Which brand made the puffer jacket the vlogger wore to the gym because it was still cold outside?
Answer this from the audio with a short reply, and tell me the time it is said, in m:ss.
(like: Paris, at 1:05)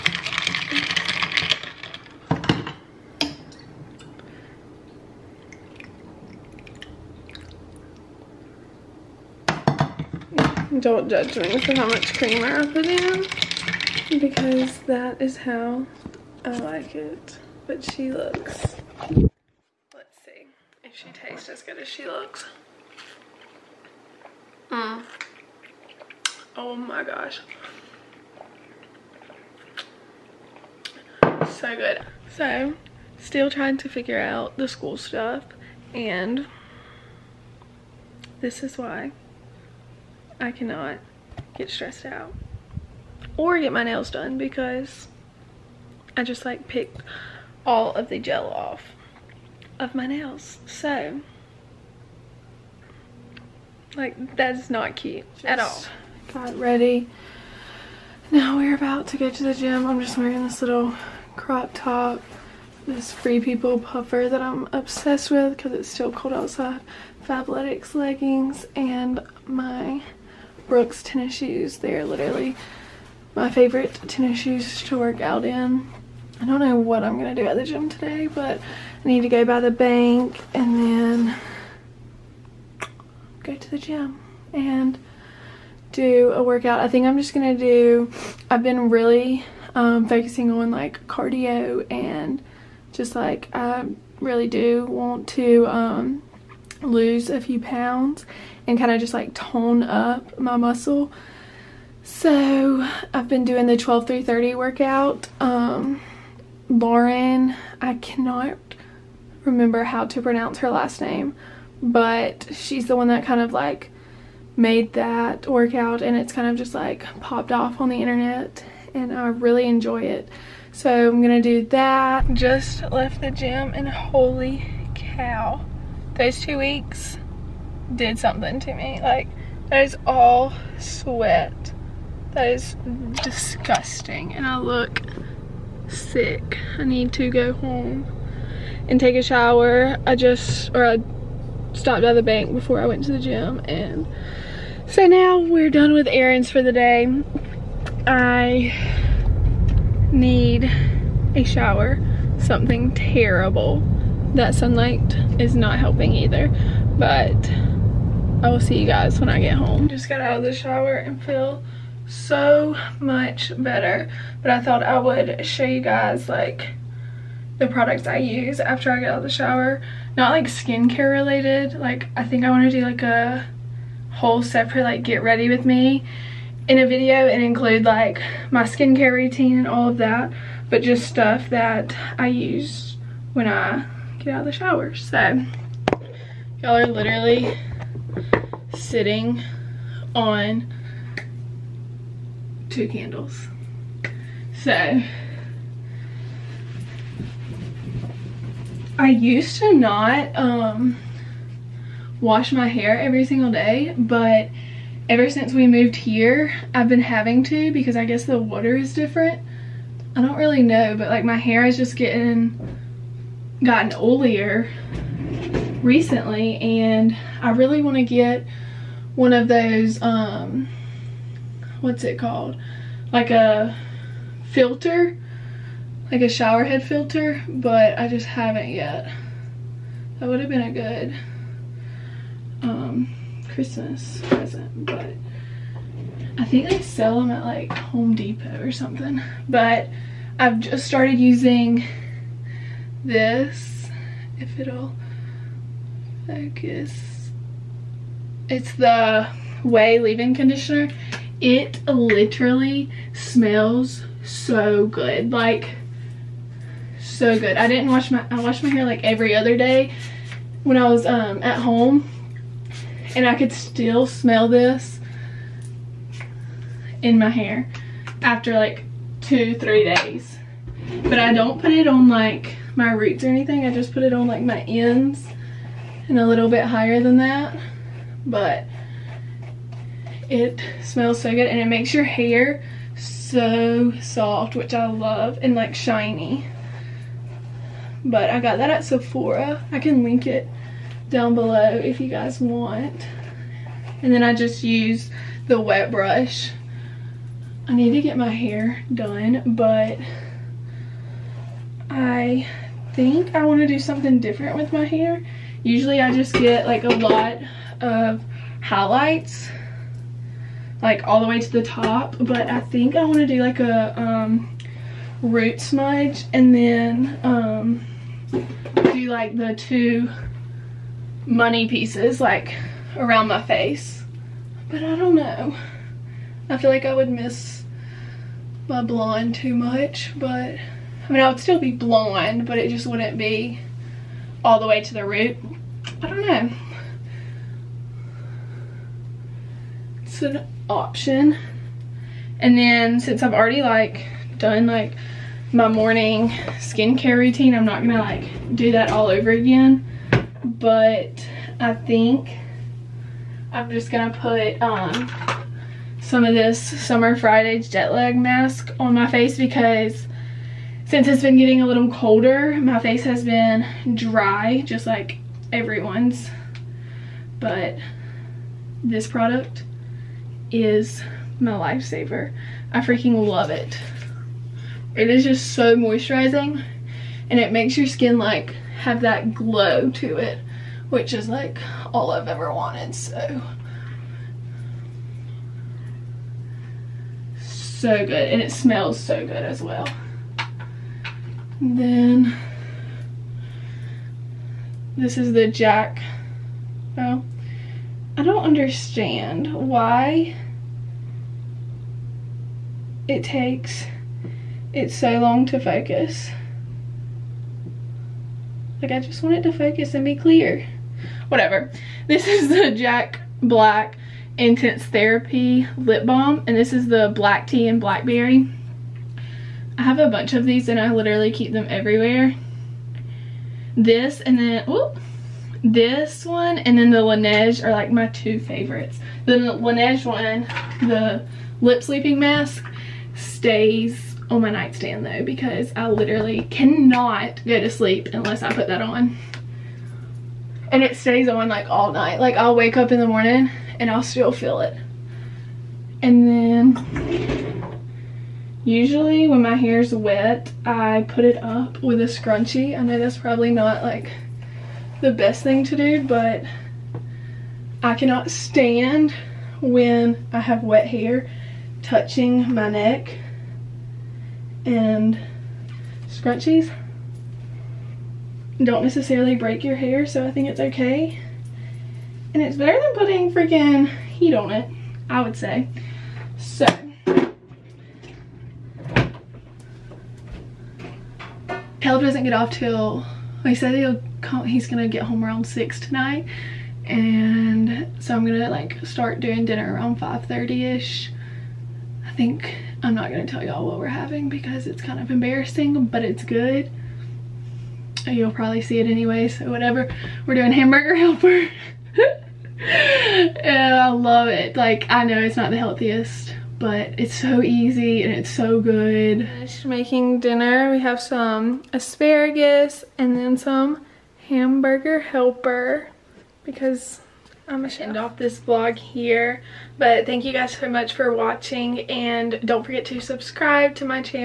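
Free People, at 1:03.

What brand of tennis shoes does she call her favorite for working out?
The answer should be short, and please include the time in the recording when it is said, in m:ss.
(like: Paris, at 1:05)
Brooks, at 1:10.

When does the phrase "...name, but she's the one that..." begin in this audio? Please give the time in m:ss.
1:51.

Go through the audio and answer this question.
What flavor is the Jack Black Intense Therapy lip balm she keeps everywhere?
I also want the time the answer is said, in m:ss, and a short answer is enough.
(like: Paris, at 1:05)
Black Tea and Blackberry, at 6:57.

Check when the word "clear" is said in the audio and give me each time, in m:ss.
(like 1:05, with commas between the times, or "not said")
6:50.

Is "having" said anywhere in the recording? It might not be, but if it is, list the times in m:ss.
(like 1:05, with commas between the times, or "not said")
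3:27, 8:13.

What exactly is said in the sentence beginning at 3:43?
Like a filter, like a shower head filter, but I just haven't yet.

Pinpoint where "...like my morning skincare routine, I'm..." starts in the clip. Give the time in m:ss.
5:44.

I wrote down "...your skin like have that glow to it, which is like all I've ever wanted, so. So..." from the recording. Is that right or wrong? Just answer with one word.
right.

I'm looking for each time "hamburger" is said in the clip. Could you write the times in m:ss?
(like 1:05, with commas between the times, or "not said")
8:20, 8:34.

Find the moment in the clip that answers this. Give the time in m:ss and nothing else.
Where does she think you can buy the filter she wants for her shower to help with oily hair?
3:57.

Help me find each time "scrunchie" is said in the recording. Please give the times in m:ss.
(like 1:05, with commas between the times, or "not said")
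7:32, 7:46.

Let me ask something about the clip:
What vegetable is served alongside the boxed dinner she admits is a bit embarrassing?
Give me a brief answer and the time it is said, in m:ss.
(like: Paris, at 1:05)
asparagus, at 8:31.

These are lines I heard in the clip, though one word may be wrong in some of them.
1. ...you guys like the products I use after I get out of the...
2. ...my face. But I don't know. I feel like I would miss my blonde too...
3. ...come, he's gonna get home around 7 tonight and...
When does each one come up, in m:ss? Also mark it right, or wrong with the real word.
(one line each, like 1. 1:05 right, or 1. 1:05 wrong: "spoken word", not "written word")
1. 2:45 right
2. 5:23 right
3. 8:04 wrong: "6", not "7".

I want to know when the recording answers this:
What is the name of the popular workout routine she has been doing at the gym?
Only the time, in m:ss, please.
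1:43.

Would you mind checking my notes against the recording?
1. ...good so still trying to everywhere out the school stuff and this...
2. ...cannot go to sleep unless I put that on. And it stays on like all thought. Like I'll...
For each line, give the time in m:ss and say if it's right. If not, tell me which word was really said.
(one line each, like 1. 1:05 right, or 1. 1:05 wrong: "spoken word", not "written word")
1. 0:31 wrong: "figure", not "everywhere"
2. 7:16 wrong: "night", not "thought".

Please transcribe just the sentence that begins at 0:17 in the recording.
But she looks, let's see if she tastes as good as she looks.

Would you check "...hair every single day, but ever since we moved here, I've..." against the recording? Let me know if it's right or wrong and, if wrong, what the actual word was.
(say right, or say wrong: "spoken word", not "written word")
right.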